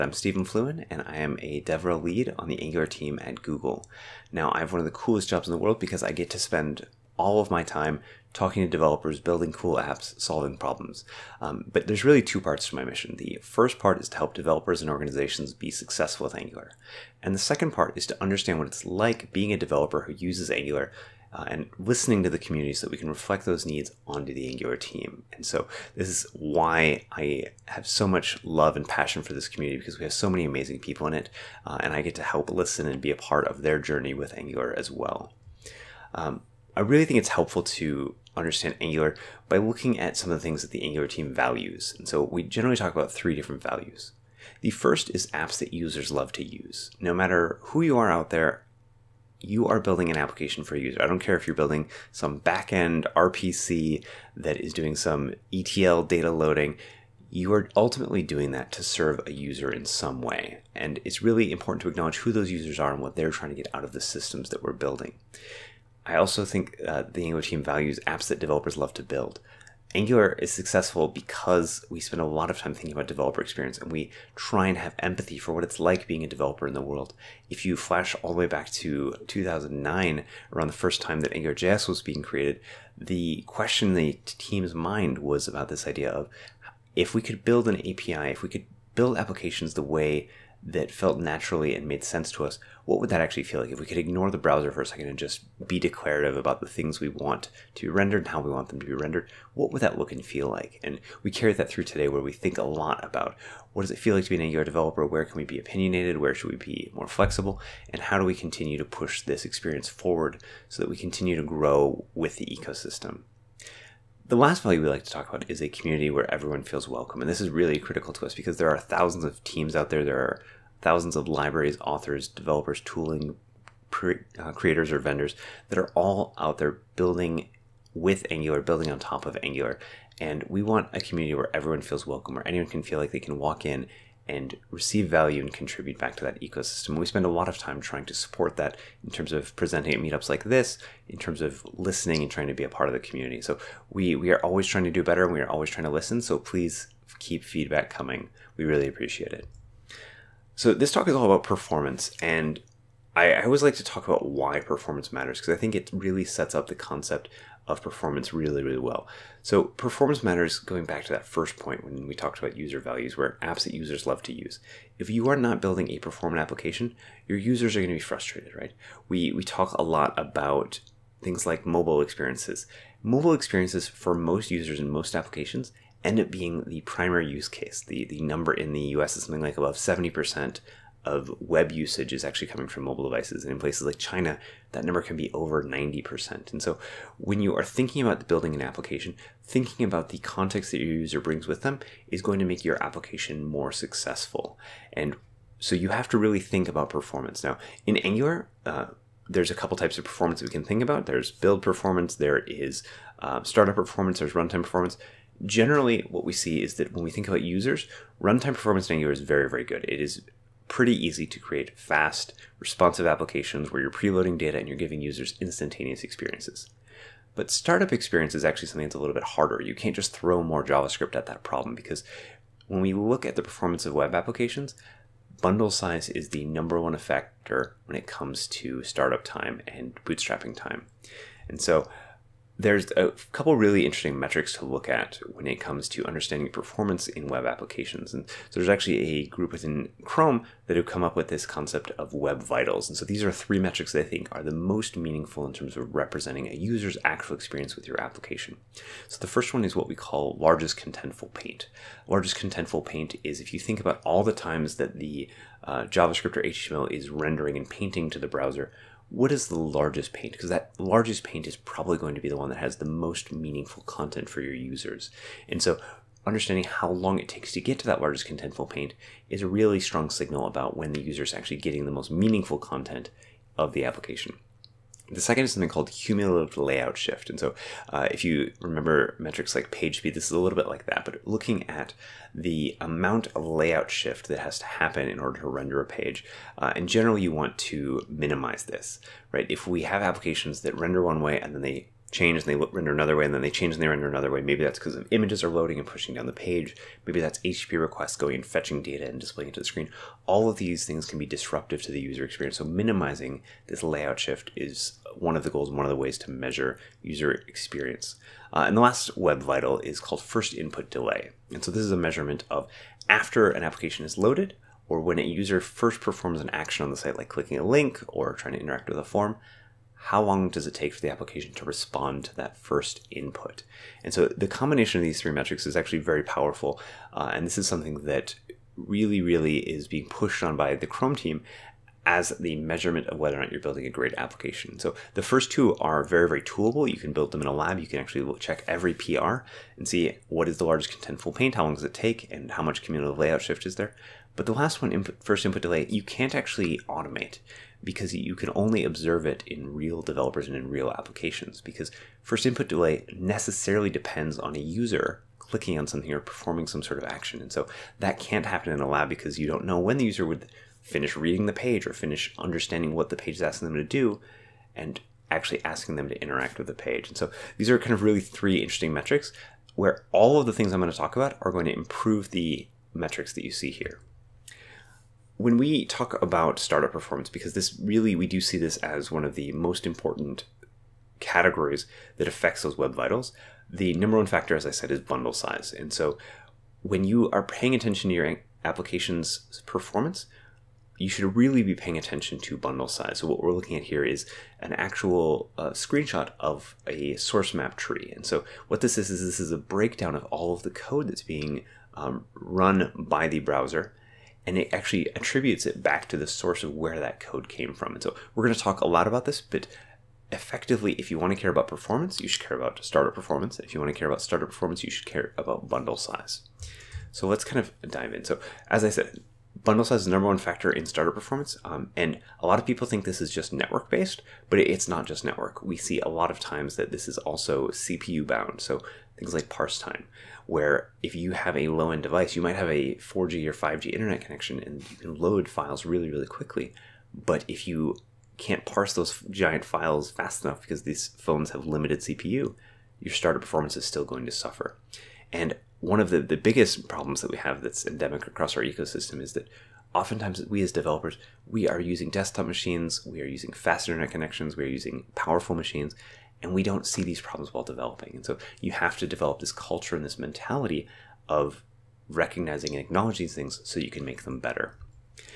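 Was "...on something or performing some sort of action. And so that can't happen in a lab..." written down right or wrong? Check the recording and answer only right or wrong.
right.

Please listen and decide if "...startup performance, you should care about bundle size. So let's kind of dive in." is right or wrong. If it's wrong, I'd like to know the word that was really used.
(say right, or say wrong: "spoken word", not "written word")
right.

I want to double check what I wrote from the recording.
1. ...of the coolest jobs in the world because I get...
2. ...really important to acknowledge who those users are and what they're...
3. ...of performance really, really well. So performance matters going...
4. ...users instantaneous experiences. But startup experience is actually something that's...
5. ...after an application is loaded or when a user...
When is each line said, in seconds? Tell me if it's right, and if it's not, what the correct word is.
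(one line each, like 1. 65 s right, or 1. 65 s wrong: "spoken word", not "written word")
1. 4 s right
2. 61 s right
3. 157 s right
4. 215 s right
5. 313 s right.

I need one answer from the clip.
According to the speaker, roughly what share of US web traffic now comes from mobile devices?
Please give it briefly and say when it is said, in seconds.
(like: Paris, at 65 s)
above 70%, at 179 s.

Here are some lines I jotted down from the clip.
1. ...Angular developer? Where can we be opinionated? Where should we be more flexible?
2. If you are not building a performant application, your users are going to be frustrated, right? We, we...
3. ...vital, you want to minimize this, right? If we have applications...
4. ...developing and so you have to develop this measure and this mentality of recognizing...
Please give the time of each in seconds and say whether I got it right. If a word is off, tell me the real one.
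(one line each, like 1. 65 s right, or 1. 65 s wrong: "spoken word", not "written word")
1. 104 s right
2. 164 s right
3. 286 s wrong: "general", not "vital"
4. 457 s wrong: "culture", not "measure".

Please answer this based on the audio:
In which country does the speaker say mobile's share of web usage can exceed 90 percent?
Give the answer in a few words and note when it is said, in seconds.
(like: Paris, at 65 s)
China, at 183 s.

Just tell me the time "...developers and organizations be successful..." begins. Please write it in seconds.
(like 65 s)
14 s.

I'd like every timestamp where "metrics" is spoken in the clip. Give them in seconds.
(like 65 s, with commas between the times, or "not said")
234 s, 243 s, 279 s, 325 s, 368 s, 372 s.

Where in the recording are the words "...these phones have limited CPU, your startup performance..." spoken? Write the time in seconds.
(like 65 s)
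440 s.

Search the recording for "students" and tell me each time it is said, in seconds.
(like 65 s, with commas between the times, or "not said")
not said.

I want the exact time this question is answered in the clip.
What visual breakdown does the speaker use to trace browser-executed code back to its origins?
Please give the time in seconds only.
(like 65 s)
397 s.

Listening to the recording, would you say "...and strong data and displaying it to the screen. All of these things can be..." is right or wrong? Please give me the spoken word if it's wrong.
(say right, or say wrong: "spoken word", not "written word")
wrong: "fetching", not "strong".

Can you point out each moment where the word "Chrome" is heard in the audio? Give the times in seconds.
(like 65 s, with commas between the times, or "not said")
240 s, 330 s.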